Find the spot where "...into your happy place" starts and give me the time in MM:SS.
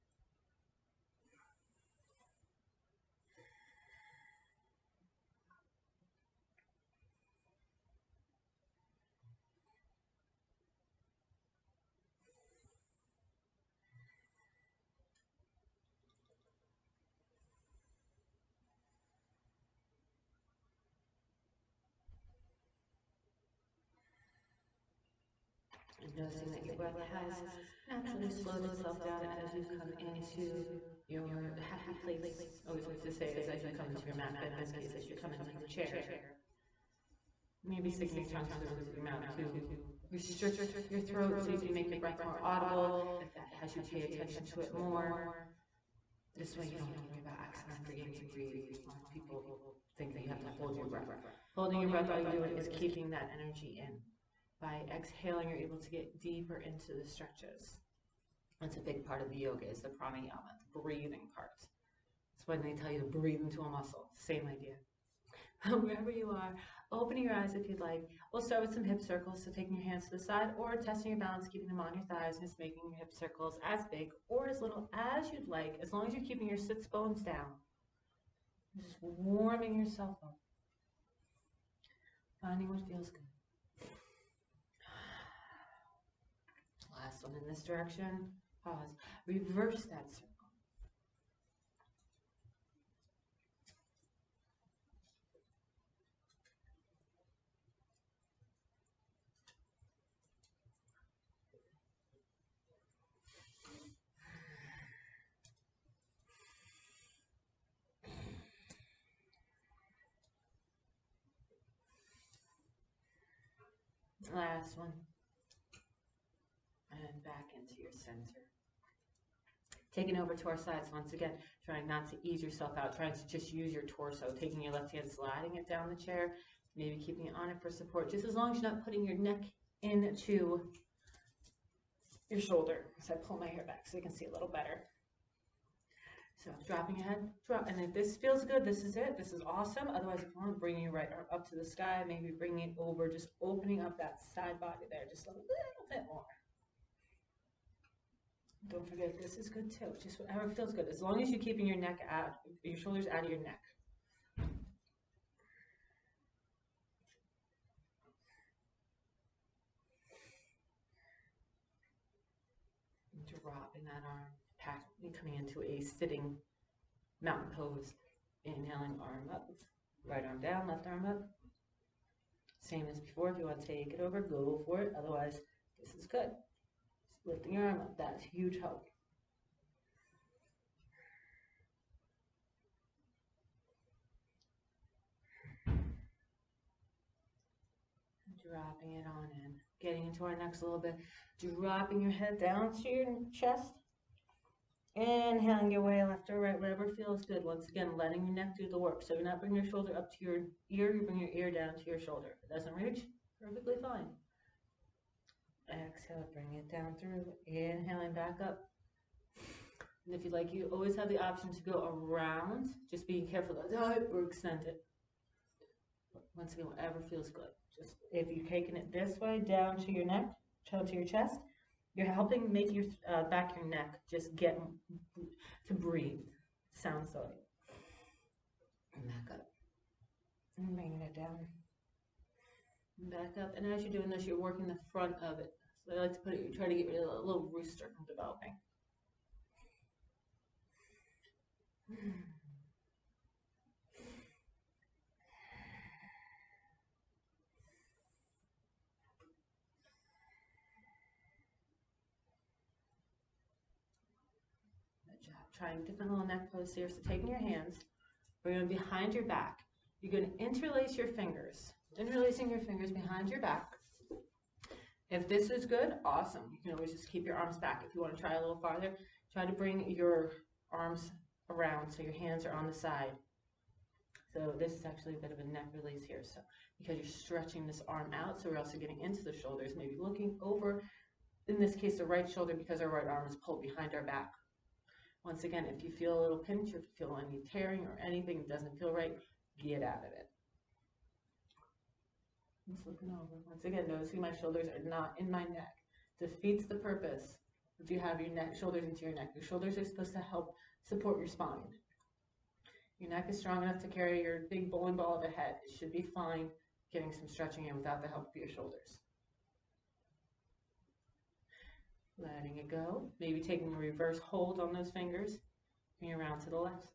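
00:29.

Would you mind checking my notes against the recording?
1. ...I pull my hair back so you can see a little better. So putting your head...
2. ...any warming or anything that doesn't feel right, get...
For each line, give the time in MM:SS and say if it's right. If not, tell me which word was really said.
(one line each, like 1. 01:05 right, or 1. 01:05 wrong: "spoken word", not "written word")
1. 02:13 wrong: "dropping", not "putting"
2. 04:47 wrong: "tearing", not "warming".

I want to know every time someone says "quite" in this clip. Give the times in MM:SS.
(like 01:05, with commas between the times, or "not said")
not said.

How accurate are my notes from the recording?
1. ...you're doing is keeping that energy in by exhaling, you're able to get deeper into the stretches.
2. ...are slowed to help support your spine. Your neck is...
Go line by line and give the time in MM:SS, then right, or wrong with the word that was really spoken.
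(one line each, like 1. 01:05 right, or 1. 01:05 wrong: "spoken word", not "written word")
1. 00:52 right
2. 04:59 wrong: "supposed", not "slowed".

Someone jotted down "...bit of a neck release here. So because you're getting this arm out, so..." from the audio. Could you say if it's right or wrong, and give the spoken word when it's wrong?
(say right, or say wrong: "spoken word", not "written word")
wrong: "stretching", not "getting".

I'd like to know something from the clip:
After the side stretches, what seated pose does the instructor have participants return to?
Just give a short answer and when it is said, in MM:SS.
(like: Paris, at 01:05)
sitting mountain pose, at 02:45.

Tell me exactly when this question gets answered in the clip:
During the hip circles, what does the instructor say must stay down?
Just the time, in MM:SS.
01:16.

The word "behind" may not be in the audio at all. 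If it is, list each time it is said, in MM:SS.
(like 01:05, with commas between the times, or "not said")
04:18, 04:22, 04:43.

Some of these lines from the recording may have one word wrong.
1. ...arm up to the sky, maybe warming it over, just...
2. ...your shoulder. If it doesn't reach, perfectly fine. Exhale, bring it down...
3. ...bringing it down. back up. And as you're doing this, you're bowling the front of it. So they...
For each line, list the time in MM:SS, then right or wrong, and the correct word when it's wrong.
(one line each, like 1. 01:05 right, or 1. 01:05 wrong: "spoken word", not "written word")
1. 02:21 wrong: "bring", not "warming"
2. 03:21 right
3. 03:50 wrong: "working", not "bowling".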